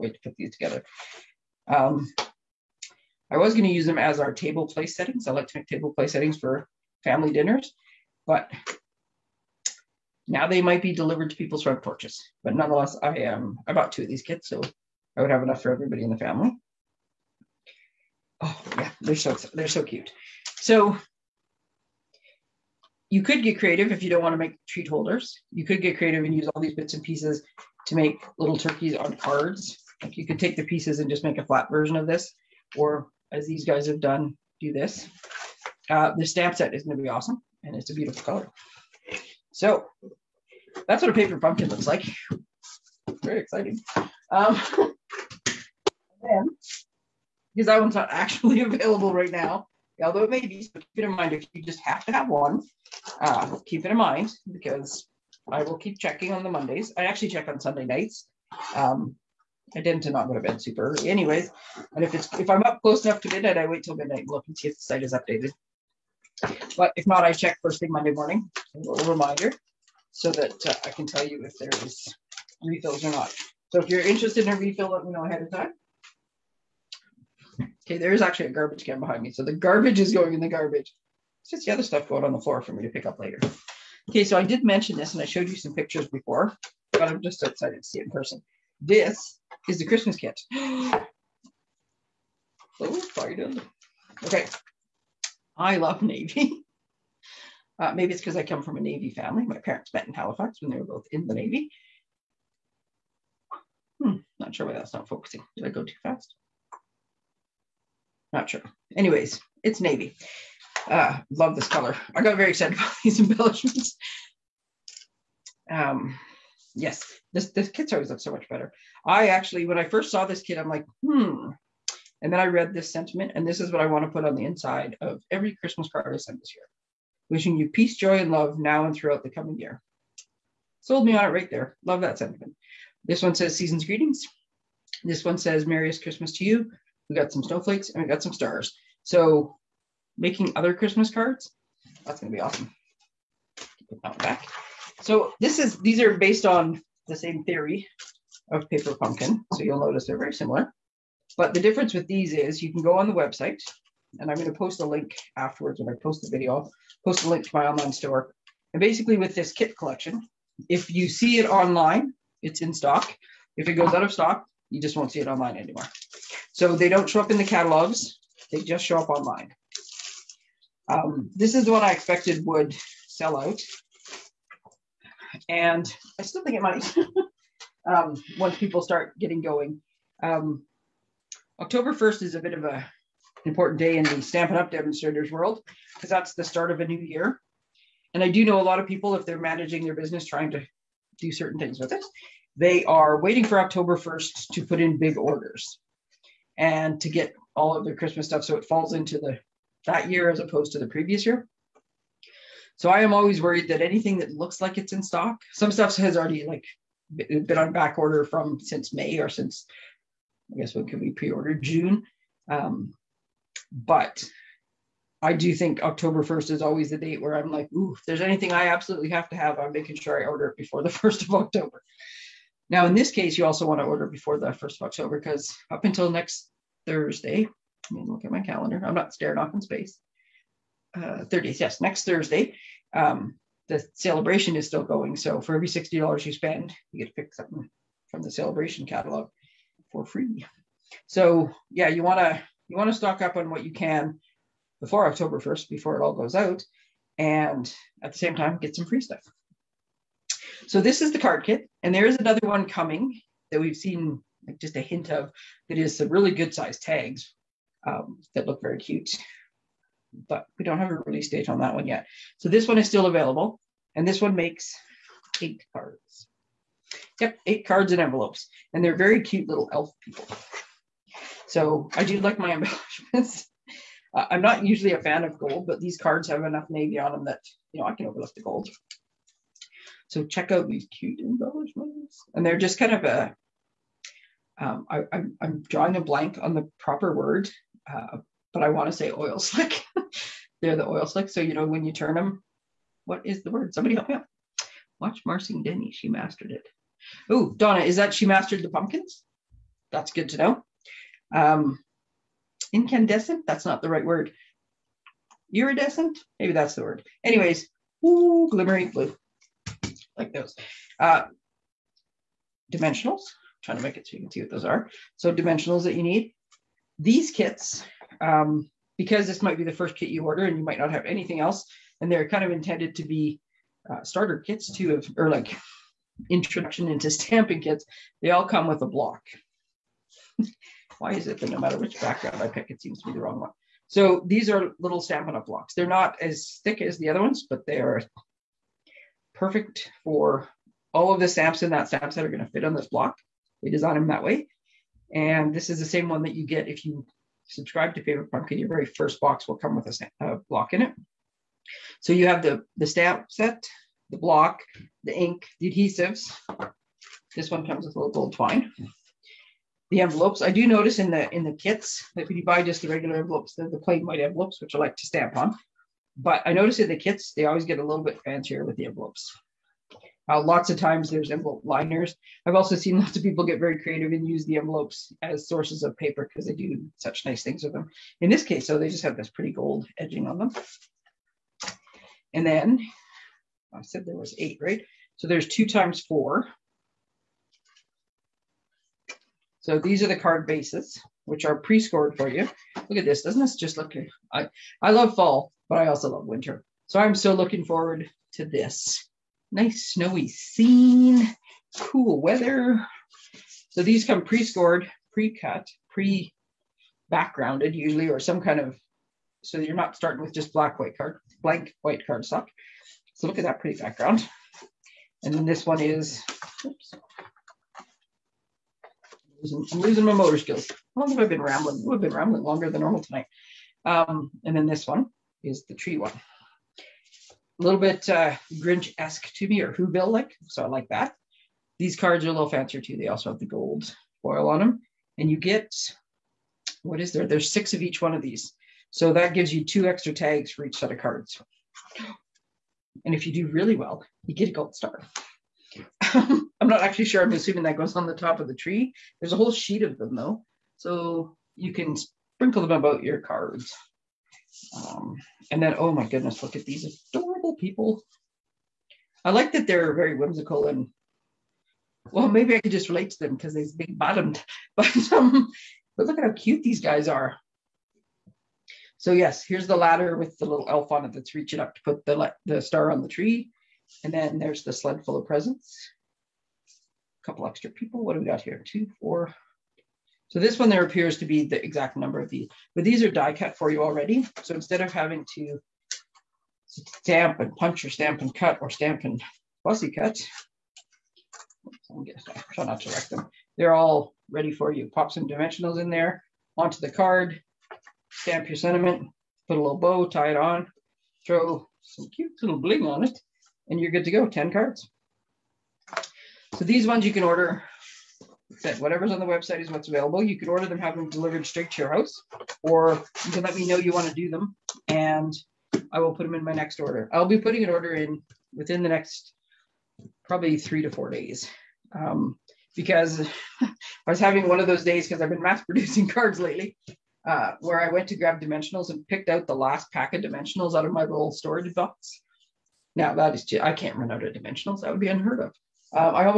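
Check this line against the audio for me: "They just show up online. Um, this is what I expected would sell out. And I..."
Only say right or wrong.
right.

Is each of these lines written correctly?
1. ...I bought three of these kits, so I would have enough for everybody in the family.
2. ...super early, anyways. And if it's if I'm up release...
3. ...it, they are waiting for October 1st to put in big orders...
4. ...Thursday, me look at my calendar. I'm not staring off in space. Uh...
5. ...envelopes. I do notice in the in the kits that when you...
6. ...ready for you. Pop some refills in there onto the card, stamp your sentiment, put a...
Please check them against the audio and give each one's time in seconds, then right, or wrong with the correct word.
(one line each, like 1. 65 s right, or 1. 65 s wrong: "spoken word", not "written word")
1. 13 s wrong: "two", not "three"
2. 60 s wrong: "close", not "release"
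3. 191 s right
4. 226 s right
5. 359 s right
6. 494 s wrong: "dimensionals", not "refills".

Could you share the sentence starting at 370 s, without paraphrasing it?
Uh, lots of times there's envelope liners.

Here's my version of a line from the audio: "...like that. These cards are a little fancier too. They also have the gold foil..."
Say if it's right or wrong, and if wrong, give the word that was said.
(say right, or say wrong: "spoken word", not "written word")
right.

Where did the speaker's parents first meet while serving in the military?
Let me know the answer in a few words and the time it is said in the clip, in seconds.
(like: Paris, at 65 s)
Halifax, at 100 s.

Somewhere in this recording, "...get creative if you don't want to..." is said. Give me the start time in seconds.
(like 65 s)
23 s.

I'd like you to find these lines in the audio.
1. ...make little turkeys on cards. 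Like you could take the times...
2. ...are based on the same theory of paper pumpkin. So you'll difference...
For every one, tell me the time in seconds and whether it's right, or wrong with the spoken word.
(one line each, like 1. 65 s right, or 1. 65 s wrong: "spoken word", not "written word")
1. 27 s wrong: "pieces", not "times"
2. 145 s wrong: "notice", not "difference".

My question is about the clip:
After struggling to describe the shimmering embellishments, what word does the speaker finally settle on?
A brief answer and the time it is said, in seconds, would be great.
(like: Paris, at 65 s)
Iridescent, at 305 s.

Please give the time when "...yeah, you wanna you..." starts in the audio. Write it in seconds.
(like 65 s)
241 s.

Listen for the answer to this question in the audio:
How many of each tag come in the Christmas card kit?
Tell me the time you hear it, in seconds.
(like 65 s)
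437 s.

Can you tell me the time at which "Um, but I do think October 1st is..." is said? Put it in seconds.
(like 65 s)
212 s.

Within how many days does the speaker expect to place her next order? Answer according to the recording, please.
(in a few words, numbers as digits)
3 to 4 days.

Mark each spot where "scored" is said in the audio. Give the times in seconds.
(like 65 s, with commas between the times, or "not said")
391 s, 404 s.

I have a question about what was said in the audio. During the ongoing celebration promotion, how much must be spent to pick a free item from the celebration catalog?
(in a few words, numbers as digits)
$60.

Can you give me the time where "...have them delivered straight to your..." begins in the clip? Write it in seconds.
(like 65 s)
510 s.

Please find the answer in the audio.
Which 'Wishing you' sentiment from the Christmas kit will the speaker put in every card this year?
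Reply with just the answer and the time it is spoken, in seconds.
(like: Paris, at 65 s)
Peace, joy, and love, at 127 s.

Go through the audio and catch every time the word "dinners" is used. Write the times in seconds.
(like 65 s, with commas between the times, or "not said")
7 s.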